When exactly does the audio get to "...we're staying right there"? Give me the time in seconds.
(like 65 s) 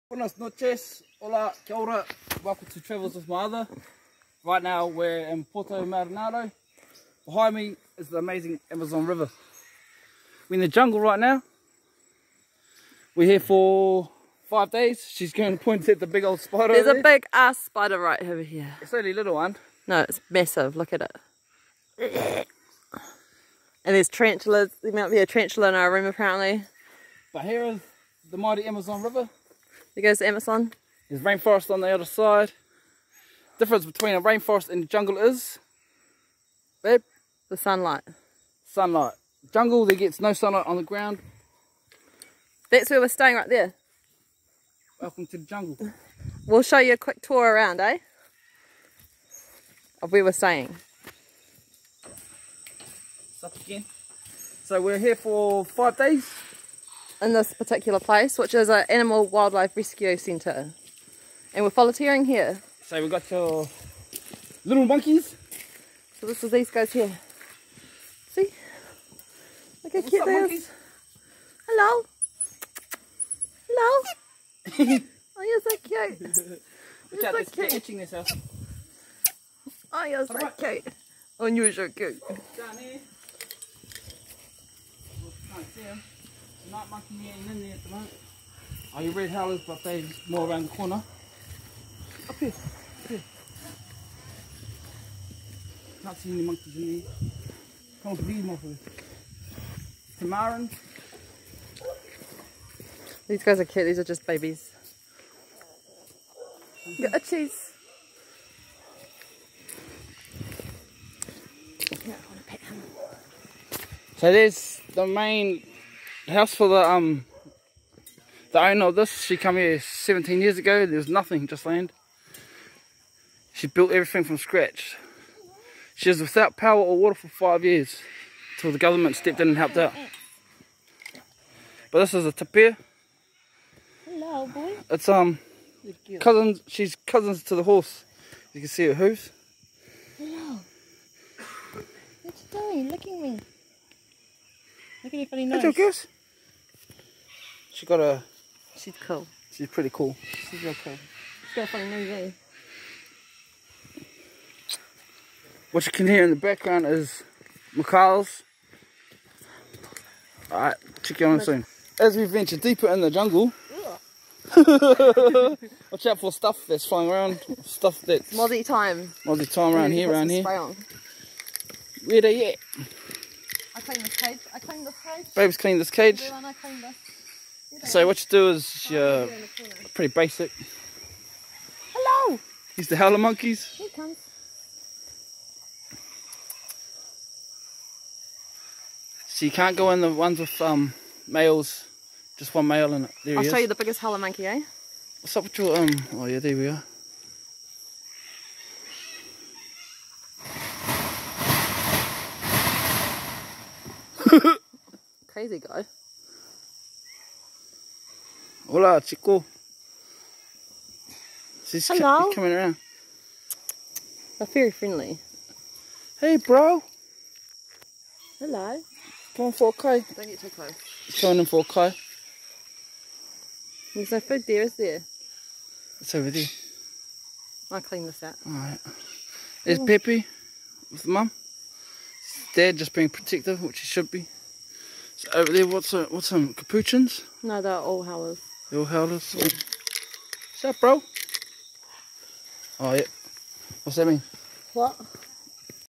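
43 s.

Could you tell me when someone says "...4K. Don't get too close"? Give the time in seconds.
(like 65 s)
219 s.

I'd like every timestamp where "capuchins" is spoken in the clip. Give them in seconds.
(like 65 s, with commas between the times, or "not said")
236 s.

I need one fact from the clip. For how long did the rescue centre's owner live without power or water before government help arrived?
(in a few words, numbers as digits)
5 years.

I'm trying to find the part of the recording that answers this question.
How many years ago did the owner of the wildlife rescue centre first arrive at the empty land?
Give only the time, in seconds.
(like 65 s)
119 s.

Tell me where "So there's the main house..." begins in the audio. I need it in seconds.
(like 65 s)
114 s.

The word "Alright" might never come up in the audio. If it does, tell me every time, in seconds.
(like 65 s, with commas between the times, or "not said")
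160 s, 228 s.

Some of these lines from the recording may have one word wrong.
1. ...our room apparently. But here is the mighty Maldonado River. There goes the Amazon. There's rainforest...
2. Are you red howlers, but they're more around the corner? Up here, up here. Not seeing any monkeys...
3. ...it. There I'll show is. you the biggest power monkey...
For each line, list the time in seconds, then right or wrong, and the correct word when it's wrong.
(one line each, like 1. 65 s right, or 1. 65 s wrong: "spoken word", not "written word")
1. 25 s wrong: "Amazon", not "Maldonado"
2. 88 s right
3. 193 s wrong: "howler", not "power".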